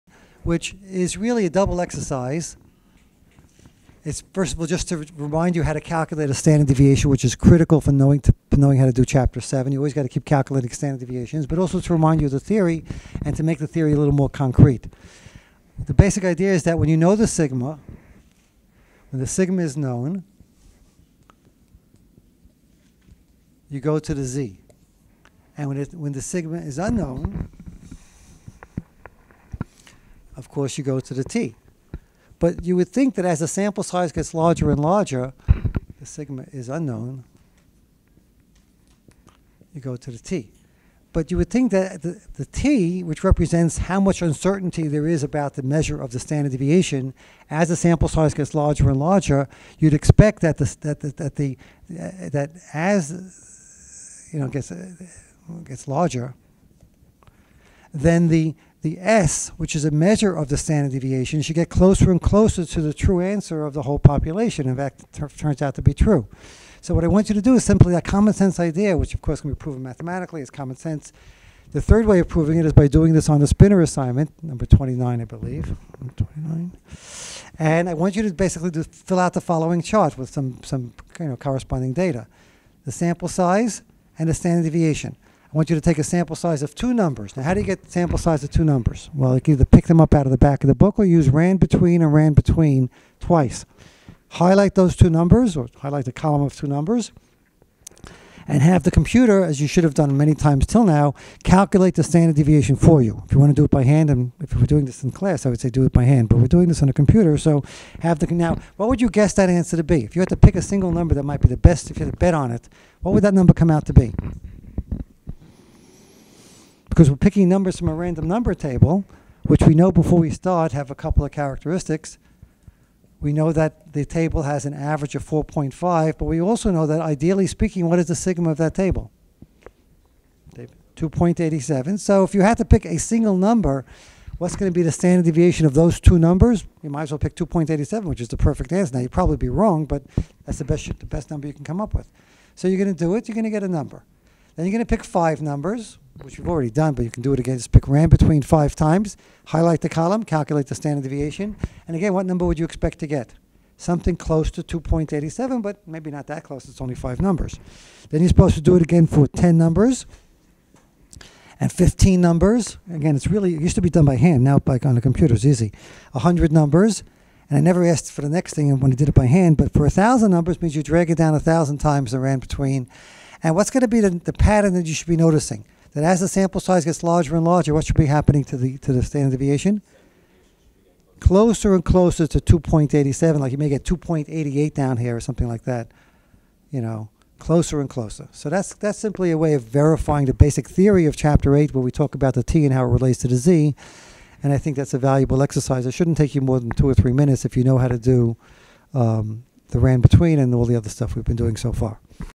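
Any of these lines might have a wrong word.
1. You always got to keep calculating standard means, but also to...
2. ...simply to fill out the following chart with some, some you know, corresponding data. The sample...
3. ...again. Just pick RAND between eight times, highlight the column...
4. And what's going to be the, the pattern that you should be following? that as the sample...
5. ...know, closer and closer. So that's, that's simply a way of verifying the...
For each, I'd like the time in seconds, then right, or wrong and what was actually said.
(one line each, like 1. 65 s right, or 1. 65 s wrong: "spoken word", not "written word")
1. 9 s wrong: "deviations", not "means"
2. 78 s wrong: "basically", not "simply"
3. 147 s wrong: "five", not "eight"
4. 173 s wrong: "noticing", not "following"
5. 186 s right.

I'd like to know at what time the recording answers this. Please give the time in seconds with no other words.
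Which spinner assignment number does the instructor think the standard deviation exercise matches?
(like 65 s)
74 s.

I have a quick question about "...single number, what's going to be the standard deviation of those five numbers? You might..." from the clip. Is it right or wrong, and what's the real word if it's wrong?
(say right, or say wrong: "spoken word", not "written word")
wrong: "two", not "five".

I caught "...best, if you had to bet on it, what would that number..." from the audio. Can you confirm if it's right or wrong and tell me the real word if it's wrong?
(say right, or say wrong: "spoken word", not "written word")
right.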